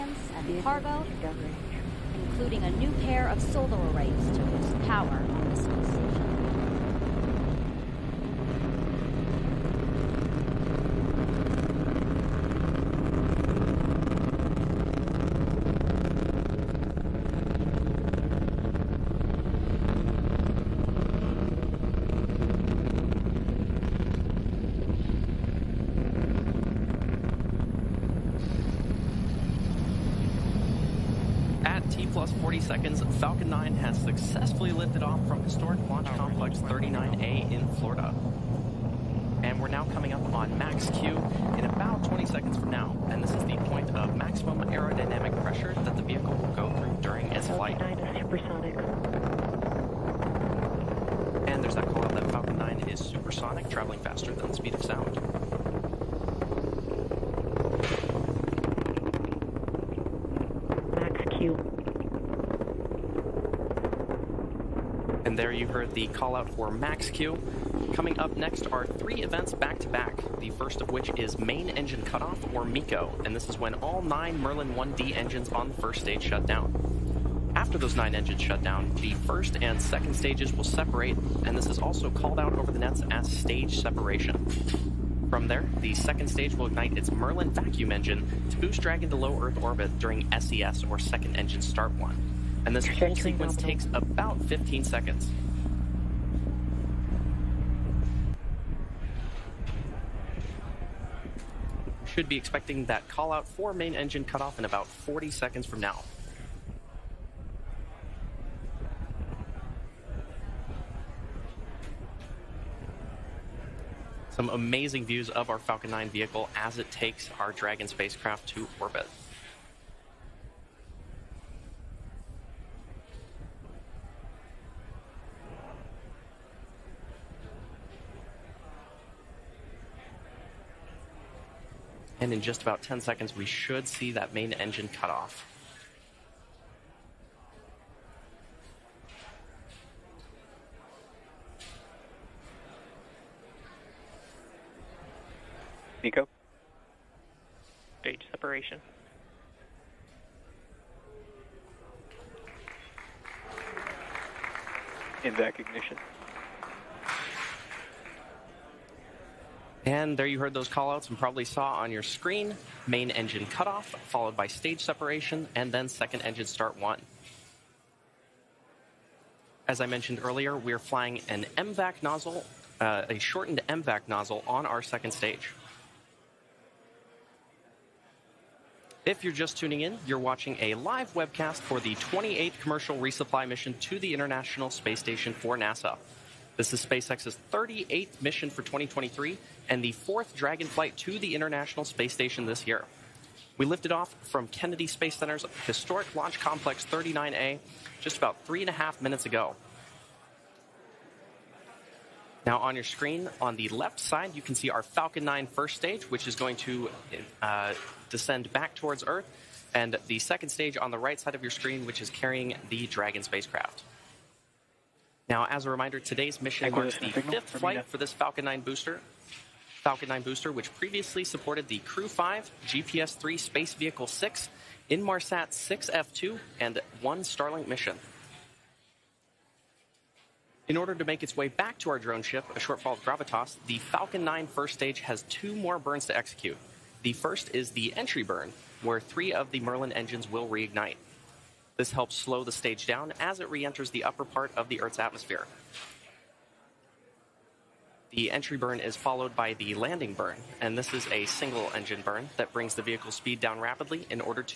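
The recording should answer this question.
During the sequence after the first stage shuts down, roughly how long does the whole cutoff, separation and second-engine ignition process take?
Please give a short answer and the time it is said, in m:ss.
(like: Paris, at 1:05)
15 seconds, at 1:34.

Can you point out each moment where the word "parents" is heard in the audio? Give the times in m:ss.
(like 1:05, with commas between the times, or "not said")
not said.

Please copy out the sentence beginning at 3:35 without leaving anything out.
Now, as a reminder, today's mission marks the fifth flight for this Falcon 9 booster.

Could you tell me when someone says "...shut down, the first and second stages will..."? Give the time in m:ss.
1:18.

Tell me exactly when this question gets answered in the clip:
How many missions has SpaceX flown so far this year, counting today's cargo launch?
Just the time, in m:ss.
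3:07.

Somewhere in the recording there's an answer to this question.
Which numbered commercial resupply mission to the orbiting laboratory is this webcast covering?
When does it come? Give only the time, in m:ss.
3:01.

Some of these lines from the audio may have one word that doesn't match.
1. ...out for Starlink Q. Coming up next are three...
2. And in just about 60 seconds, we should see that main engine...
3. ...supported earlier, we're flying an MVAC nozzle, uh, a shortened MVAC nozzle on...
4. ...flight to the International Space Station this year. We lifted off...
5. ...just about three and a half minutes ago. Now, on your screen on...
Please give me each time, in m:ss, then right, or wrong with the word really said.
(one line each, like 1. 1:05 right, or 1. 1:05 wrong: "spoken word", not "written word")
1. 1:06 wrong: "Max", not "Starlink"
2. 2:12 wrong: "10", not "60"
3. 2:49 wrong: "mentioned", not "supported"
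4. 3:10 right
5. 3:18 right.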